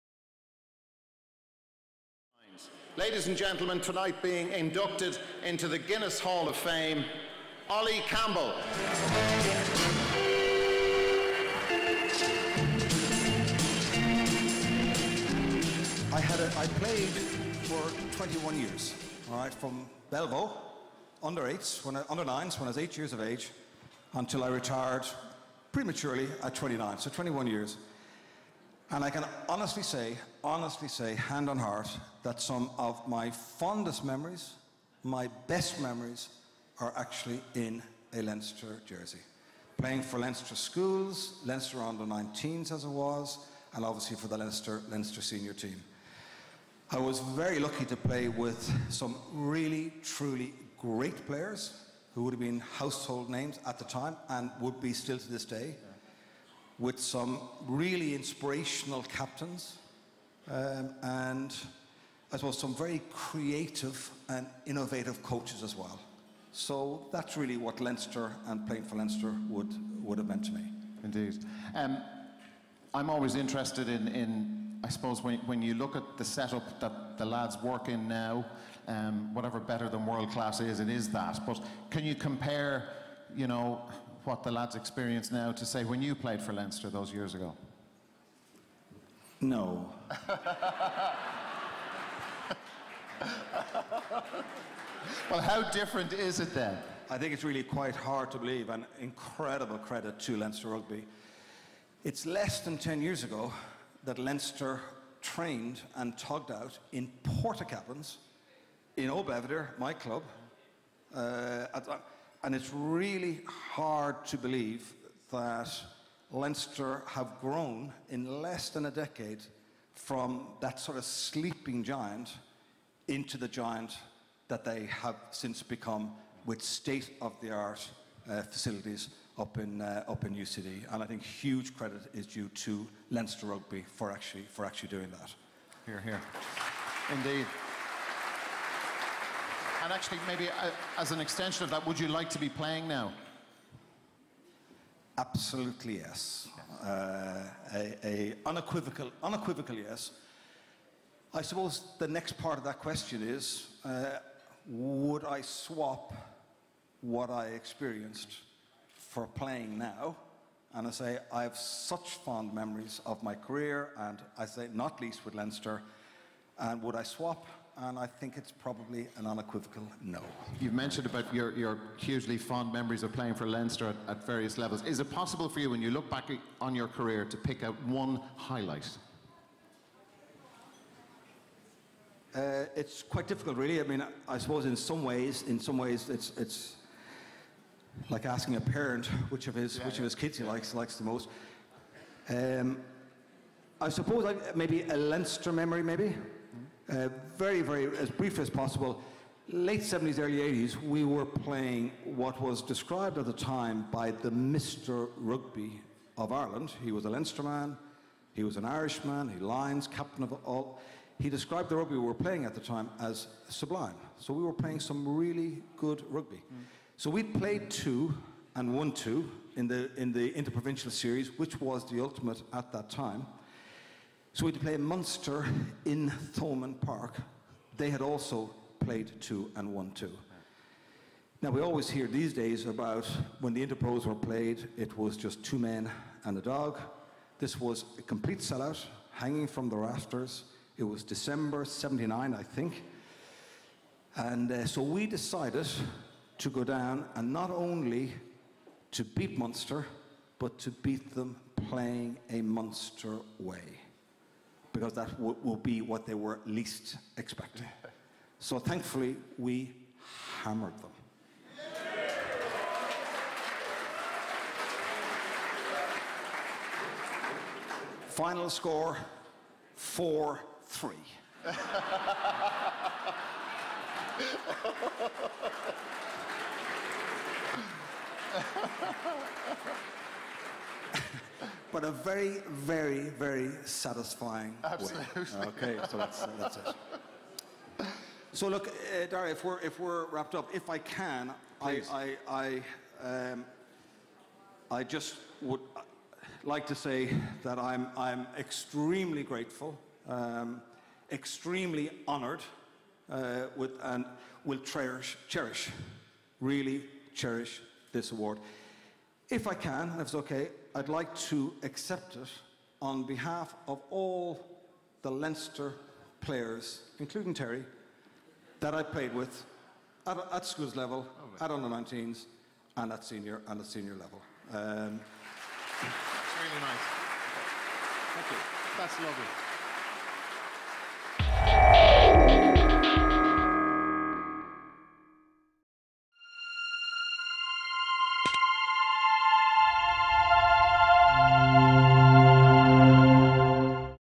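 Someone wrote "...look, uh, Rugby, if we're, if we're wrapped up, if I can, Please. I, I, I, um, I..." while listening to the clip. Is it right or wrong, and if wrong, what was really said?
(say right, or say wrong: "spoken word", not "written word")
wrong: "Dara", not "Rugby".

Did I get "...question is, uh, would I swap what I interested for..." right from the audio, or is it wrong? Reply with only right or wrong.
wrong.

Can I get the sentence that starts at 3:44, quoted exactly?
So we'd play Munster in Thomond Park.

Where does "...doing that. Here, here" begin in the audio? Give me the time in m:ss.
2:14.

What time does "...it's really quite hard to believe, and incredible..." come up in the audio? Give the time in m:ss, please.
1:37.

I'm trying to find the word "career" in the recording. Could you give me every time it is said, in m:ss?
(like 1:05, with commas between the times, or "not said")
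2:43, 2:56.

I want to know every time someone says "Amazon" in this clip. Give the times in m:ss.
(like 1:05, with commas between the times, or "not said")
not said.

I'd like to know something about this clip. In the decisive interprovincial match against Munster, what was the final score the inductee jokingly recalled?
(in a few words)
4-3.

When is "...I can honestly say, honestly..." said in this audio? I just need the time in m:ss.
0:29.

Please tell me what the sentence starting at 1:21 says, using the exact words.
But can you compare, you know, what the lads experience now to say when you played for Leinster those years ago?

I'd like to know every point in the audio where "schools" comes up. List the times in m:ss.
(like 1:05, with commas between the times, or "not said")
0:40, 5:20.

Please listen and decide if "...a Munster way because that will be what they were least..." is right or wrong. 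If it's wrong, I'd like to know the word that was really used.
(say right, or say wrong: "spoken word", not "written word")
right.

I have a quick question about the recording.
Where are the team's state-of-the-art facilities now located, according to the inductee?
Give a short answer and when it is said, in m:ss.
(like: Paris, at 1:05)
UCD, at 2:10.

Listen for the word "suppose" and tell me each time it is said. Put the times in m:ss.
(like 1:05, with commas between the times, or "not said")
1:02, 1:14, 2:31, 3:04, 3:13.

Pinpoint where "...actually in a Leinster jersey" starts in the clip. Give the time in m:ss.
0:36.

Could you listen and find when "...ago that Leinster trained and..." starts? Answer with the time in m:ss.
1:43.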